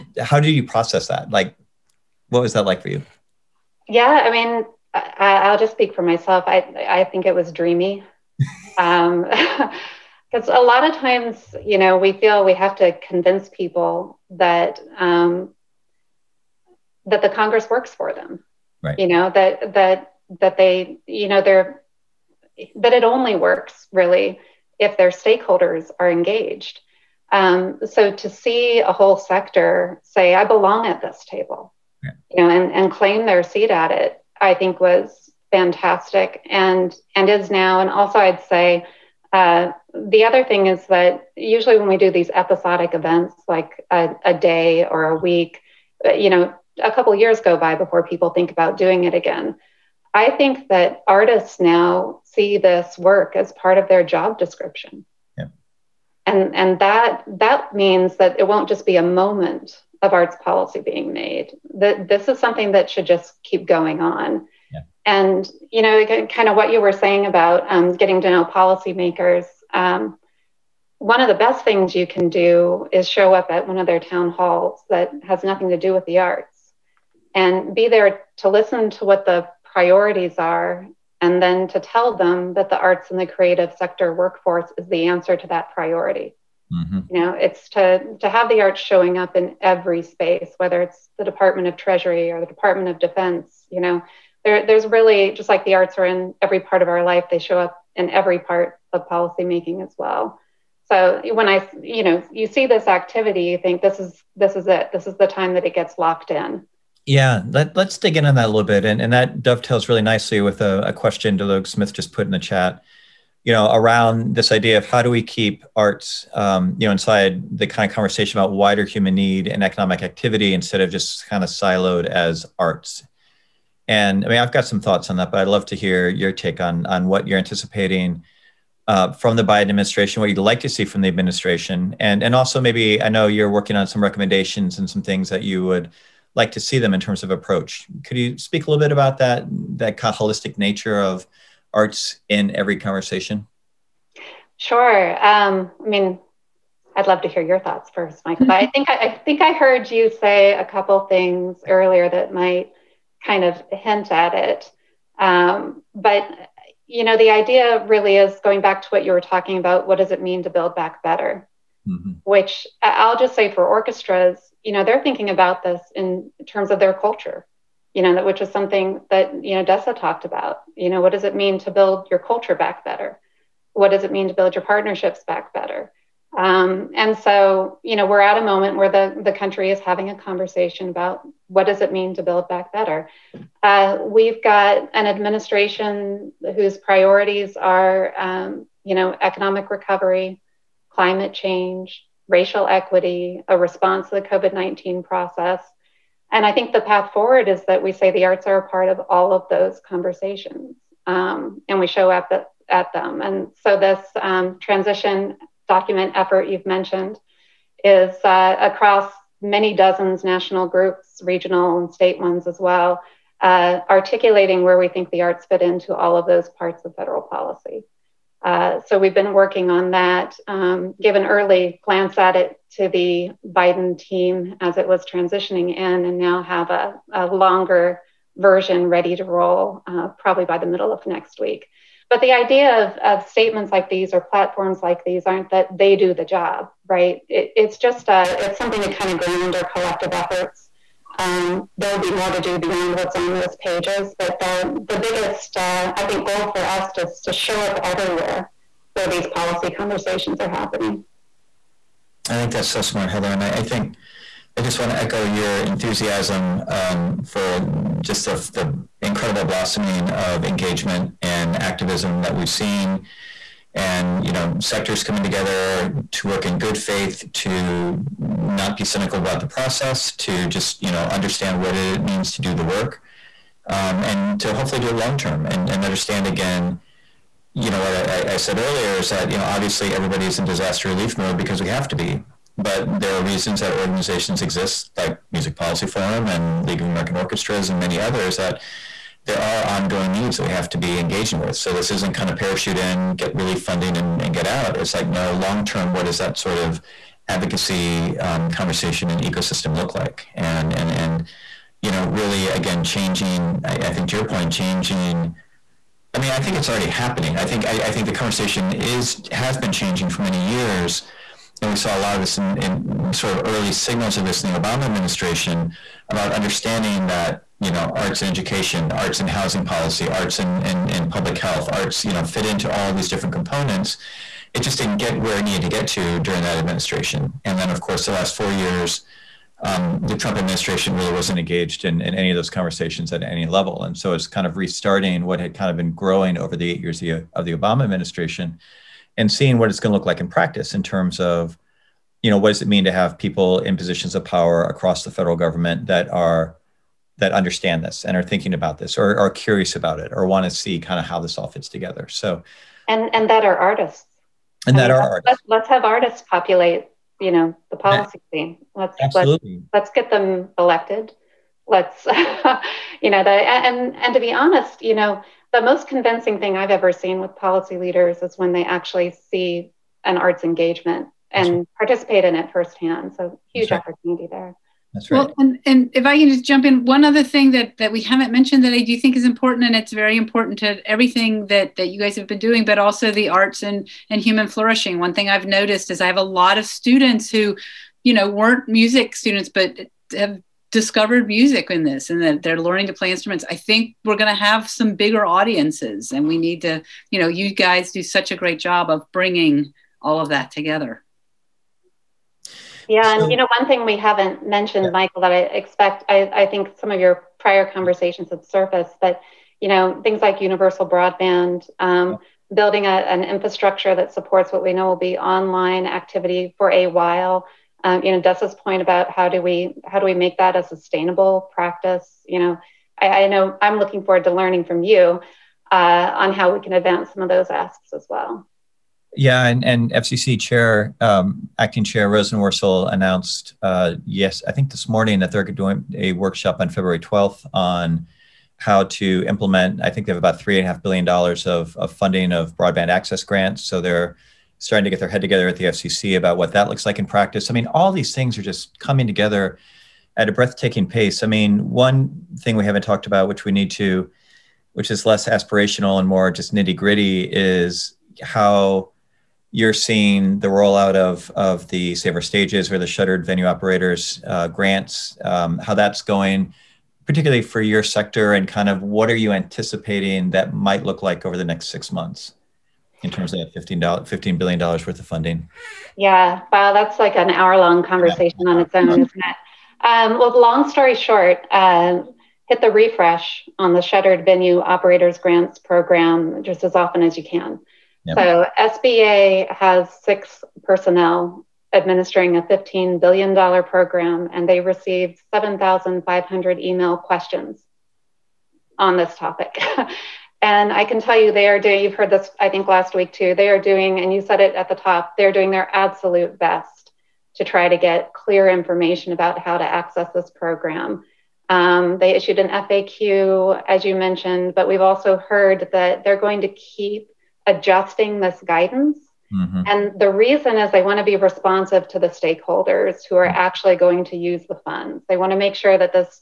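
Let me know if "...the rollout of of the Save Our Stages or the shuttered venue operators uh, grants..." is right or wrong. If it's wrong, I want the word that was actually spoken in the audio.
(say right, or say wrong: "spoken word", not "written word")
right.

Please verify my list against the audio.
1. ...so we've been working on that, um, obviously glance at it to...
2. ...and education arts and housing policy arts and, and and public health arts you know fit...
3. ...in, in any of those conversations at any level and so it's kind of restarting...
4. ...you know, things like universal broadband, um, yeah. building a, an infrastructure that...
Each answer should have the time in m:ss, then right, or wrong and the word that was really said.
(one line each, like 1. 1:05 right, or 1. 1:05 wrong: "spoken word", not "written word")
1. 3:38 wrong: "early", not "obviously"
2. 5:18 right
3. 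5:31 right
4. 6:49 right.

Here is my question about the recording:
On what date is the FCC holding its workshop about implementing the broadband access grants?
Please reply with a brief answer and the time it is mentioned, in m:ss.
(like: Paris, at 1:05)
February 12, at 7:16.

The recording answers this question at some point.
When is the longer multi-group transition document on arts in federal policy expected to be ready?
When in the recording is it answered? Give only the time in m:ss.
3:50.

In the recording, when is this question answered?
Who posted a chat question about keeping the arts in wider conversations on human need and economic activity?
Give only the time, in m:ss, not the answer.
1:51.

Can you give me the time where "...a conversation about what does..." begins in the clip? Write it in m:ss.
3:00.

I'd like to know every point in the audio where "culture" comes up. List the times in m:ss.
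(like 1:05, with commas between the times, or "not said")
2:46, 2:52.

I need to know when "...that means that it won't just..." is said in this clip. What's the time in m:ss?
0:57.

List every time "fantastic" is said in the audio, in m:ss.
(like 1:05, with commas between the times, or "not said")
0:35.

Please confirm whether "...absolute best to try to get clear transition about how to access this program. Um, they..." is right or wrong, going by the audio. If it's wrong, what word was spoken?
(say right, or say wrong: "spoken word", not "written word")
wrong: "information", not "transition".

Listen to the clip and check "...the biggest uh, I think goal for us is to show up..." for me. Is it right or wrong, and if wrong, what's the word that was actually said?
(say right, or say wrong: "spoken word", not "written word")
right.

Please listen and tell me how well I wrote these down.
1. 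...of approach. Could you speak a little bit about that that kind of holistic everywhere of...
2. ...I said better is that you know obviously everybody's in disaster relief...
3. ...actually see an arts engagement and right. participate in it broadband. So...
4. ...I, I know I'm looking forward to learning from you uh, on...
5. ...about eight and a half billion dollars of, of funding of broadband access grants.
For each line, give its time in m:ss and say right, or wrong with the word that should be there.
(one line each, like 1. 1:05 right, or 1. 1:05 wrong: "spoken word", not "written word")
1. 2:17 wrong: "nature", not "everywhere"
2. 4:38 wrong: "earlier", not "better"
3. 6:08 wrong: "firsthand", not "broadband"
4. 7:02 right
5. 7:20 wrong: "three", not "eight".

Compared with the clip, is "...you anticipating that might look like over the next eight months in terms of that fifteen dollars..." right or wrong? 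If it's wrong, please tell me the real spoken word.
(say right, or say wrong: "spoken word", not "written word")
wrong: "six", not "eight".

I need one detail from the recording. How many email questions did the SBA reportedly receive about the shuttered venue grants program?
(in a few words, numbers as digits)
7,500.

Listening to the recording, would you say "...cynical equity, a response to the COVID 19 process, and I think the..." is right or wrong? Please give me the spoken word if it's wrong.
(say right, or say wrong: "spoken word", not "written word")
wrong: "racial", not "cynical".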